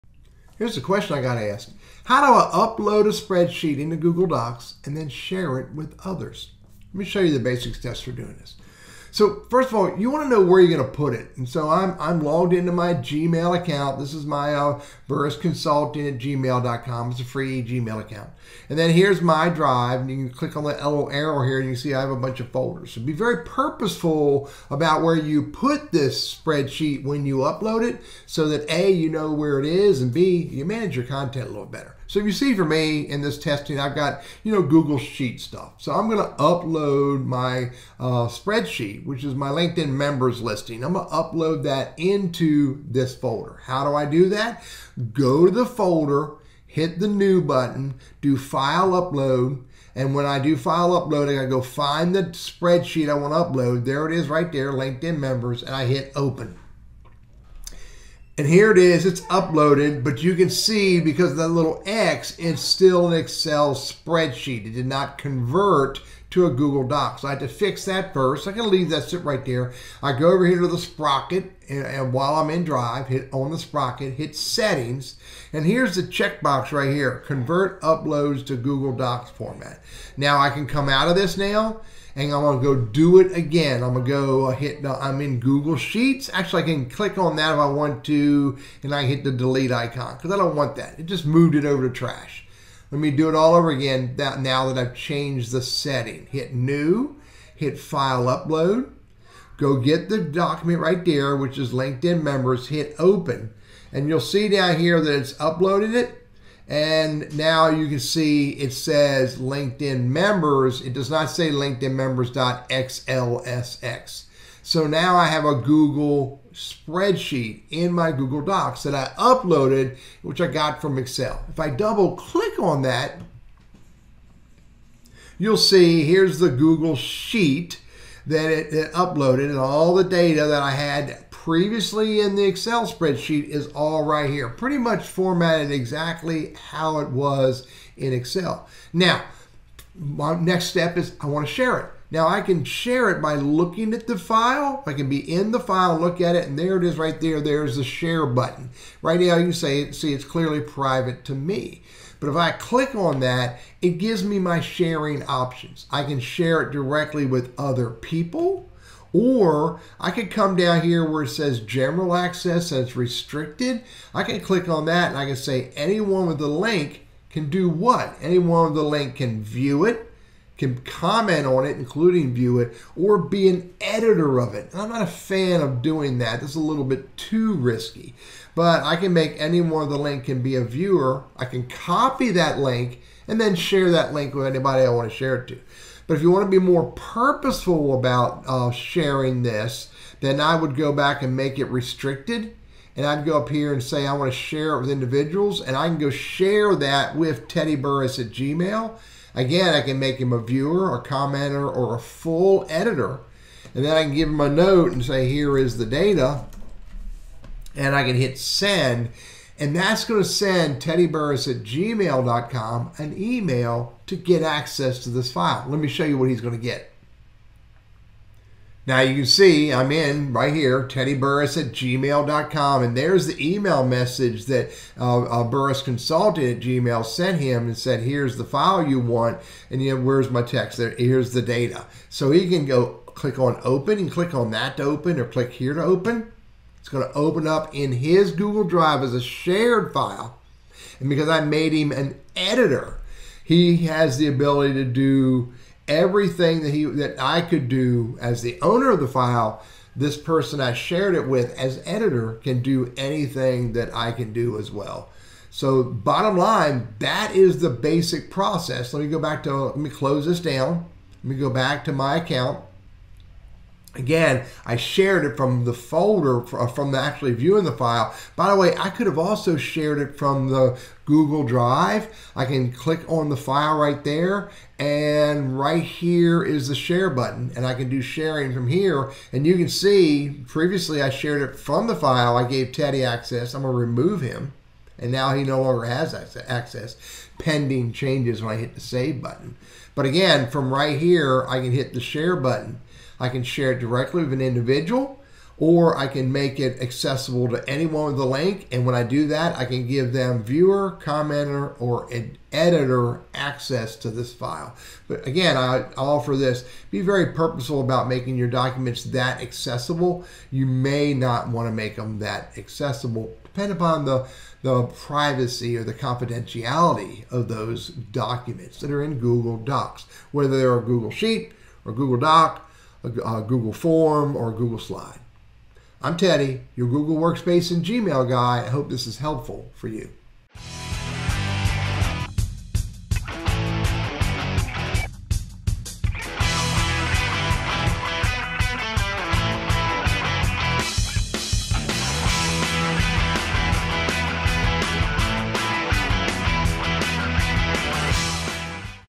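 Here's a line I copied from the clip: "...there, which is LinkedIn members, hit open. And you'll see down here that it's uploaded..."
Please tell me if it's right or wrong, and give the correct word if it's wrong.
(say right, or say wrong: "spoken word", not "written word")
right.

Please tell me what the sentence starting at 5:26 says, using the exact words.
I'm Teddy, your Google Workspace and Gmail guy.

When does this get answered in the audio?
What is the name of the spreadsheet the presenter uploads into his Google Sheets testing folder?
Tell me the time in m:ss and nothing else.
0:39.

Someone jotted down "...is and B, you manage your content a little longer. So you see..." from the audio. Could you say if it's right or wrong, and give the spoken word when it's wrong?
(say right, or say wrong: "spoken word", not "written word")
wrong: "better", not "longer".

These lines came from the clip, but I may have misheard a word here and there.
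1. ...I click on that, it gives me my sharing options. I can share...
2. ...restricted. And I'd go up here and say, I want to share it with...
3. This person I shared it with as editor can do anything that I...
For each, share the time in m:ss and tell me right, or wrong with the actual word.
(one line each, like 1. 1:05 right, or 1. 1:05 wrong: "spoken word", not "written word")
1. 2:32 right
2. 3:11 right
3. 4:09 right.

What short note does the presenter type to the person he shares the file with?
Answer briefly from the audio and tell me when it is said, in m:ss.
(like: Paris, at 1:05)
Here is the data, at 3:25.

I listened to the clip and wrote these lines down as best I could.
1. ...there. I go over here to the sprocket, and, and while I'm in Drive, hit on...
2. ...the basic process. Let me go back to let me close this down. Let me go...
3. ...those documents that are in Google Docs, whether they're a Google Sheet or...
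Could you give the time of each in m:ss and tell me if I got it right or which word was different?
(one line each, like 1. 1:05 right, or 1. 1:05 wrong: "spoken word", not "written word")
1. 1:09 right
2. 4:17 right
3. 5:17 right.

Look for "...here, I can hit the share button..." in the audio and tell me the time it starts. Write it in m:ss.
4:50.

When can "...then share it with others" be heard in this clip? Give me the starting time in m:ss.
0:04.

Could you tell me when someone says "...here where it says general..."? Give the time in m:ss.
2:40.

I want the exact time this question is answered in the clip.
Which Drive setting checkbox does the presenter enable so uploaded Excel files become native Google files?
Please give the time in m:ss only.
1:17.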